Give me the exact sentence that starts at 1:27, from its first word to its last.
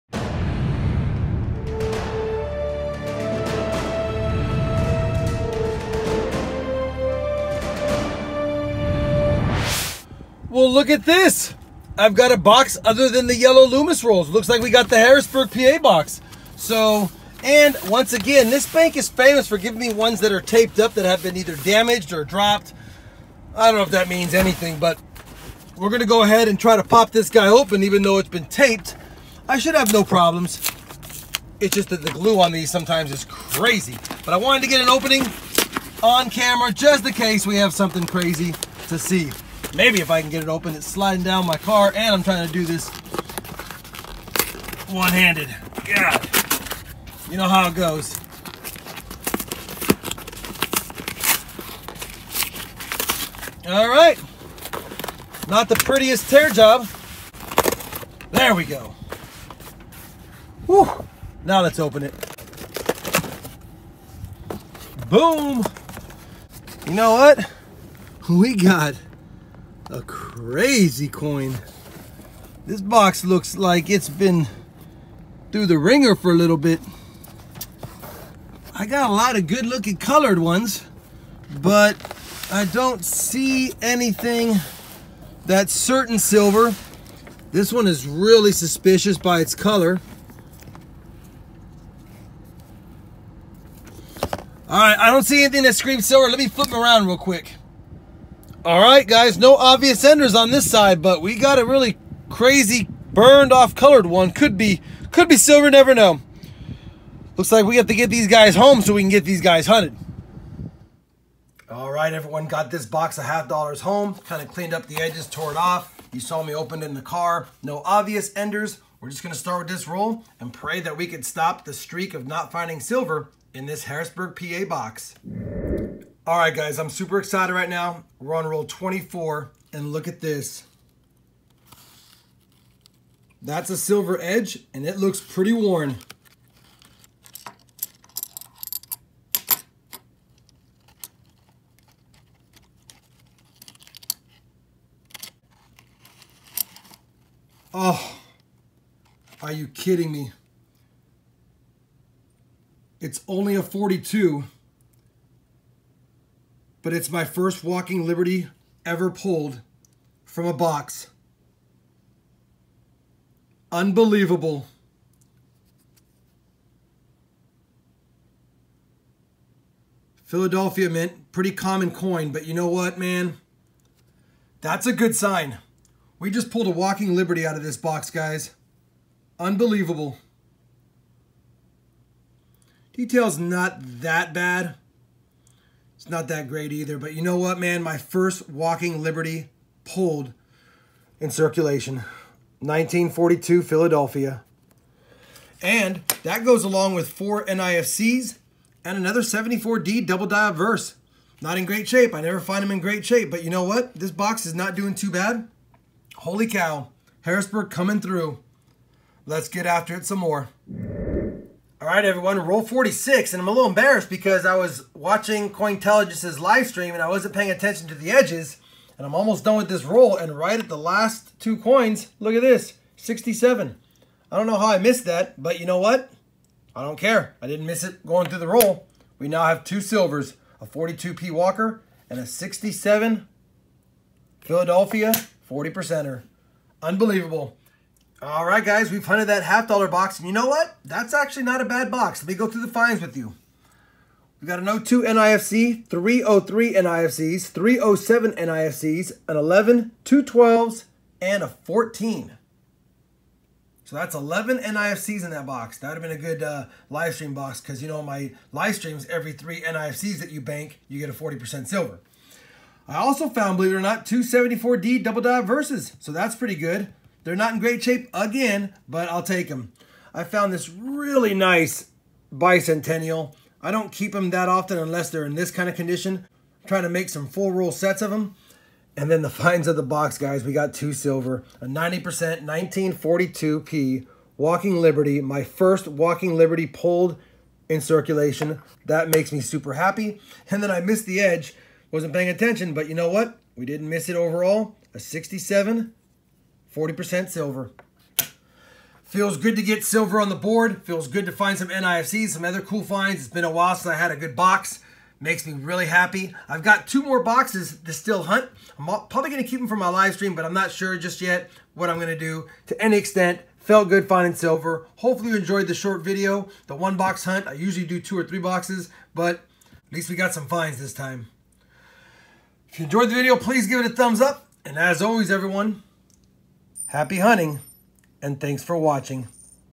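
This one is really suspicious by its color.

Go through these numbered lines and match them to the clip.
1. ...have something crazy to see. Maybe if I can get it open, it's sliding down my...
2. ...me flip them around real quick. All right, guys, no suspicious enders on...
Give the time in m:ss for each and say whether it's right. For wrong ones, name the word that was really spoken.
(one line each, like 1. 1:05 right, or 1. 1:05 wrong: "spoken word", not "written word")
1. 0:37 right
2. 1:36 wrong: "obvious", not "suspicious".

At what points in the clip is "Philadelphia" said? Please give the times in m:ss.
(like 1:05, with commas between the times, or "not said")
2:50, 3:13, 3:54.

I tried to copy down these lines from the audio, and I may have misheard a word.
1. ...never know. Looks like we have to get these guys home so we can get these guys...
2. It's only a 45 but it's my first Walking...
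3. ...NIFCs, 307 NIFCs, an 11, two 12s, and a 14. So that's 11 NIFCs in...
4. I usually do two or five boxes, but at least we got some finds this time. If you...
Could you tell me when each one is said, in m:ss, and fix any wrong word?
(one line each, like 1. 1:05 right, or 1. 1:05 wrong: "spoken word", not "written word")
1. 1:45 right
2. 2:32 wrong: "42", not "45"
3. 4:06 right
4. 5:17 wrong: "three", not "five".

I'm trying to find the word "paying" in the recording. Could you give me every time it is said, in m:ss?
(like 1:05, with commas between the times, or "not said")
3:37, 4:52.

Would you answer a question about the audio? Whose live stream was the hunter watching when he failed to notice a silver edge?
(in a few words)
Cointelligence.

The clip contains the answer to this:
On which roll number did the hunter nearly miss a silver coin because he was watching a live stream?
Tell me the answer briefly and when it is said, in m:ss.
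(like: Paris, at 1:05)
46, at 3:32.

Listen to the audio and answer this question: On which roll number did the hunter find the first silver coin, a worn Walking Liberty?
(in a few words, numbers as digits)
24.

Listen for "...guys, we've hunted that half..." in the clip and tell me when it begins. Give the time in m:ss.
3:58.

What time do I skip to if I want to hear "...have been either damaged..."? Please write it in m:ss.
0:21.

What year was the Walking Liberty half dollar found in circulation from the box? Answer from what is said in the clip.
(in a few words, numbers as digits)
1942.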